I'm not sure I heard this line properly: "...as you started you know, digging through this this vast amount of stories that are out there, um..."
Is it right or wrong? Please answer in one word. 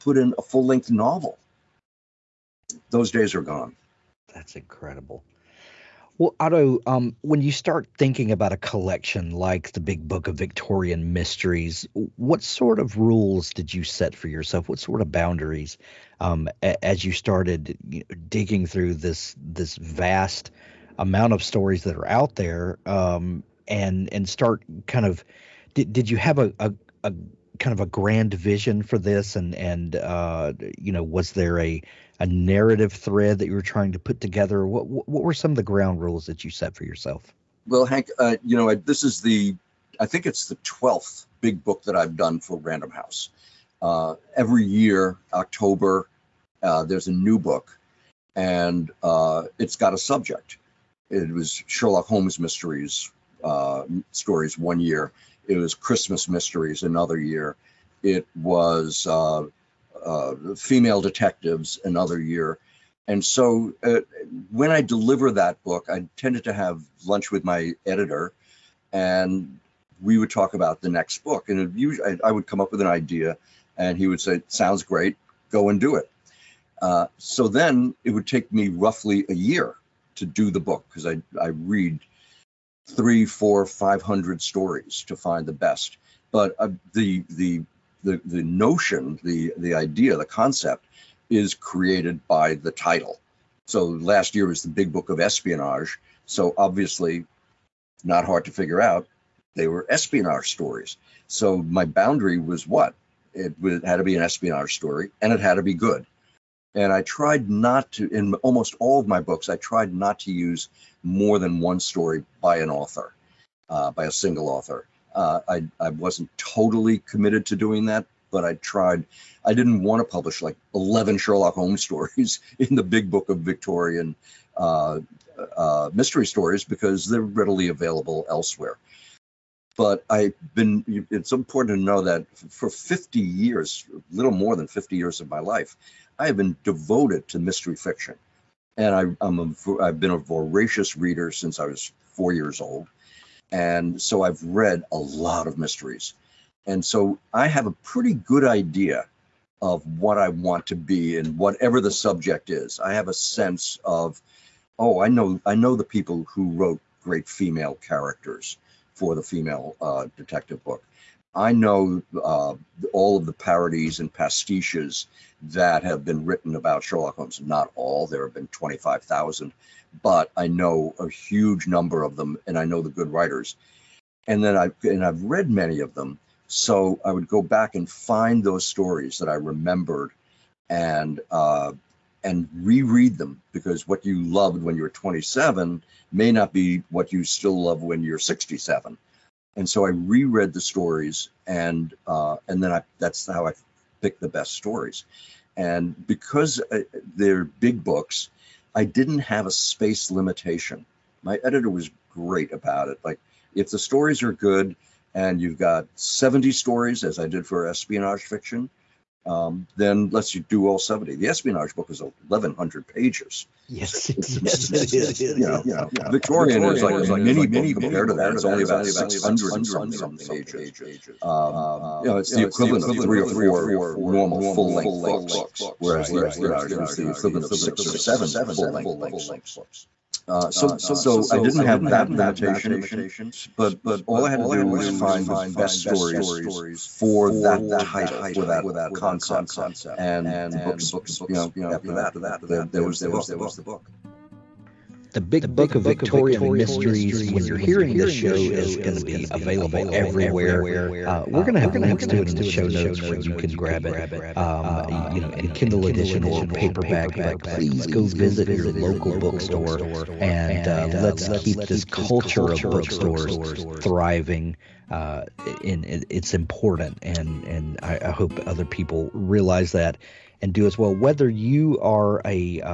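right.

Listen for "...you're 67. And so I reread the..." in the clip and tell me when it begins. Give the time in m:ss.
3:08.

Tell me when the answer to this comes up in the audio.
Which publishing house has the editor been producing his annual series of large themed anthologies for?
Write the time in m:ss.
0:42.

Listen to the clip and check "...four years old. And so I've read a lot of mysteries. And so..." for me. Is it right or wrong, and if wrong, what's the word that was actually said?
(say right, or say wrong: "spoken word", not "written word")
right.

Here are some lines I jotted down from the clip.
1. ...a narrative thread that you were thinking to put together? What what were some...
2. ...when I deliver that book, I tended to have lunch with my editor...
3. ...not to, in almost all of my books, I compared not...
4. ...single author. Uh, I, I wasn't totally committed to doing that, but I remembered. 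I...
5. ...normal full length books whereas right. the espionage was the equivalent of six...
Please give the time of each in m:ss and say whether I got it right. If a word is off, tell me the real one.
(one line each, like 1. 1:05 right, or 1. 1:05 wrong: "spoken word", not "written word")
1. 0:32 wrong: "trying", not "thinking"
2. 1:04 right
3. 1:47 wrong: "tried", not "compared"
4. 1:54 wrong: "tried", not "remembered"
5. 3:43 right.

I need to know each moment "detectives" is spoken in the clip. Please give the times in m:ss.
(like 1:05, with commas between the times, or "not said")
1:01, 2:40.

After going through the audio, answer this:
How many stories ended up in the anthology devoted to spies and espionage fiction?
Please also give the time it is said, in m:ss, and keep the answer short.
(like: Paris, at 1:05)
70, at 3:25.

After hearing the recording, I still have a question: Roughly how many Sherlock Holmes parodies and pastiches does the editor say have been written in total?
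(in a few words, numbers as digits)
25,000.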